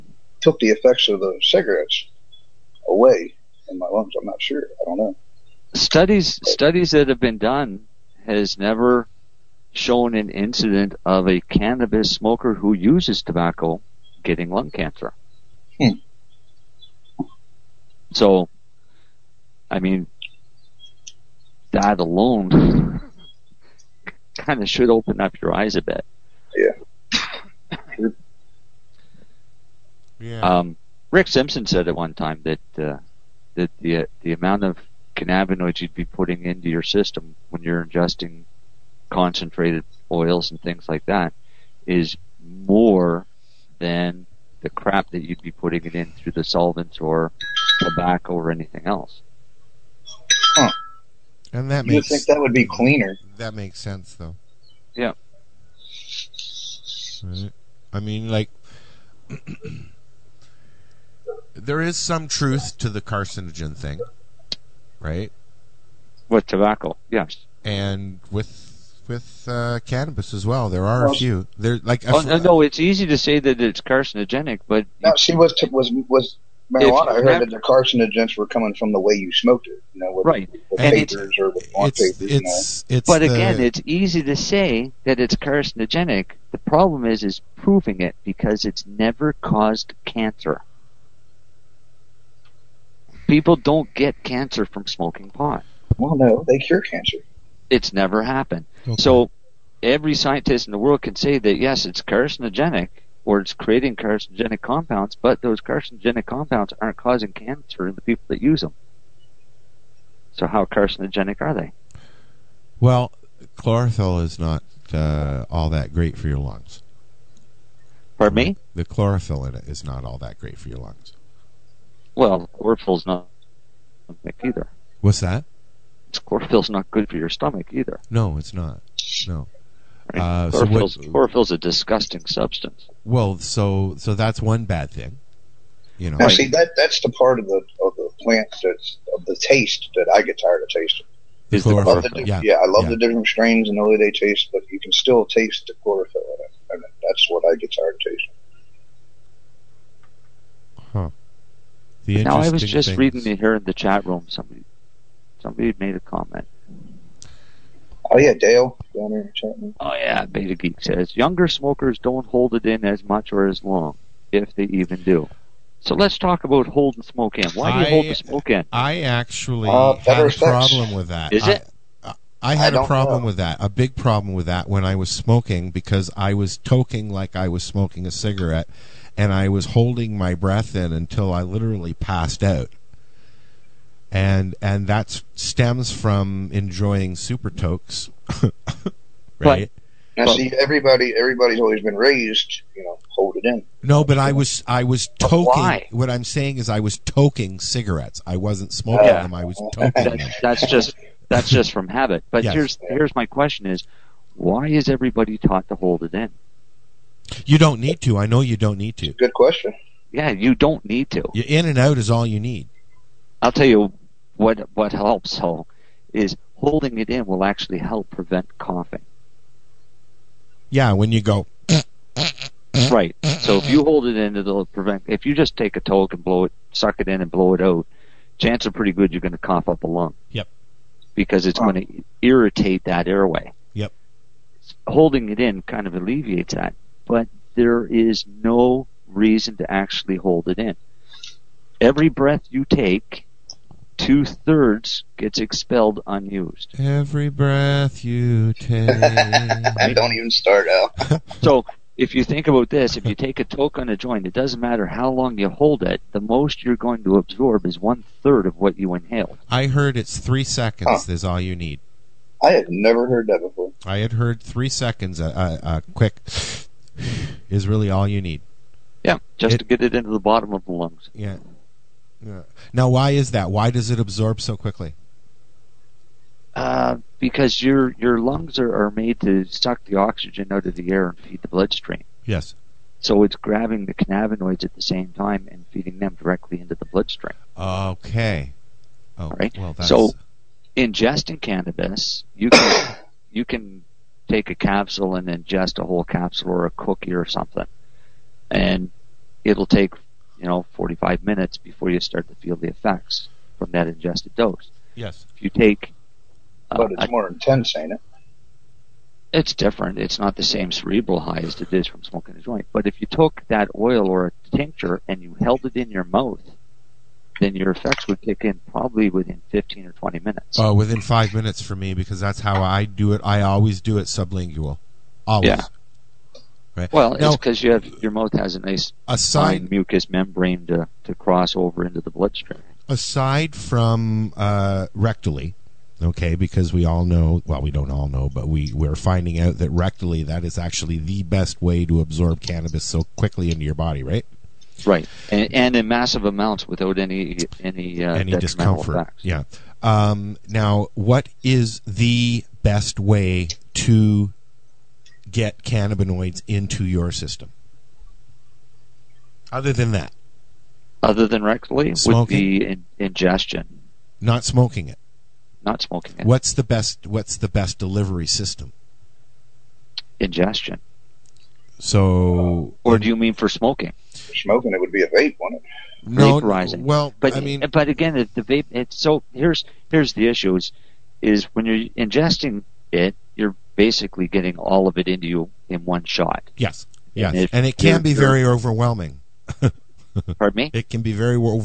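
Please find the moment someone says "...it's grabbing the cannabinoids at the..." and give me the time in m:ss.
4:43.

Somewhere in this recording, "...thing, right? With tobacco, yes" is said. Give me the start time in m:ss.
1:03.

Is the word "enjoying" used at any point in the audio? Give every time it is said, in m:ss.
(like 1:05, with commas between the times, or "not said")
3:06.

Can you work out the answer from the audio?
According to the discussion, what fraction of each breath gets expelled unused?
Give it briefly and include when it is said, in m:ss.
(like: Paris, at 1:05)
2/3, at 4:03.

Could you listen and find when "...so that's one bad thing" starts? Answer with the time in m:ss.
2:13.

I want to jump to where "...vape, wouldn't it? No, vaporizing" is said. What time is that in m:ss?
6:15.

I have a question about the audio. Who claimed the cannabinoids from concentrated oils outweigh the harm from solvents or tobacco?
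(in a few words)
Rick Simpson.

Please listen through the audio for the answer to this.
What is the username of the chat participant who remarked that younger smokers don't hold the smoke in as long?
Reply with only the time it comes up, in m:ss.
2:40.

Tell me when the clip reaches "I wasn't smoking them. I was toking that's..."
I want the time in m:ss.
3:18.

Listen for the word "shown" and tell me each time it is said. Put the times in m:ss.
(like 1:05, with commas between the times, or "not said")
0:09.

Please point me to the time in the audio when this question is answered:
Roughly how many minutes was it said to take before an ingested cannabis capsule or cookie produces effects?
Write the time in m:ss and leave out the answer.
5:00.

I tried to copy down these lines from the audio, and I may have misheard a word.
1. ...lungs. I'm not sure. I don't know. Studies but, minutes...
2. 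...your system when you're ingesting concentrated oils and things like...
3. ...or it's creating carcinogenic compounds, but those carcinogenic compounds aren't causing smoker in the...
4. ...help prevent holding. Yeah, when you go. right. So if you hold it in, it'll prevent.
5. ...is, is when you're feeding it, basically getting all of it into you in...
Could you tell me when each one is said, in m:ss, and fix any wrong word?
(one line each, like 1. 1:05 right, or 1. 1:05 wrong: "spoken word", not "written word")
1. 0:03 wrong: "studies", not "minutes"
2. 0:36 right
3. 1:43 wrong: "cancer", not "smoker"
4. 3:37 wrong: "coughing", not "holding"
5. 6:20 wrong: "ingesting", not "feeding".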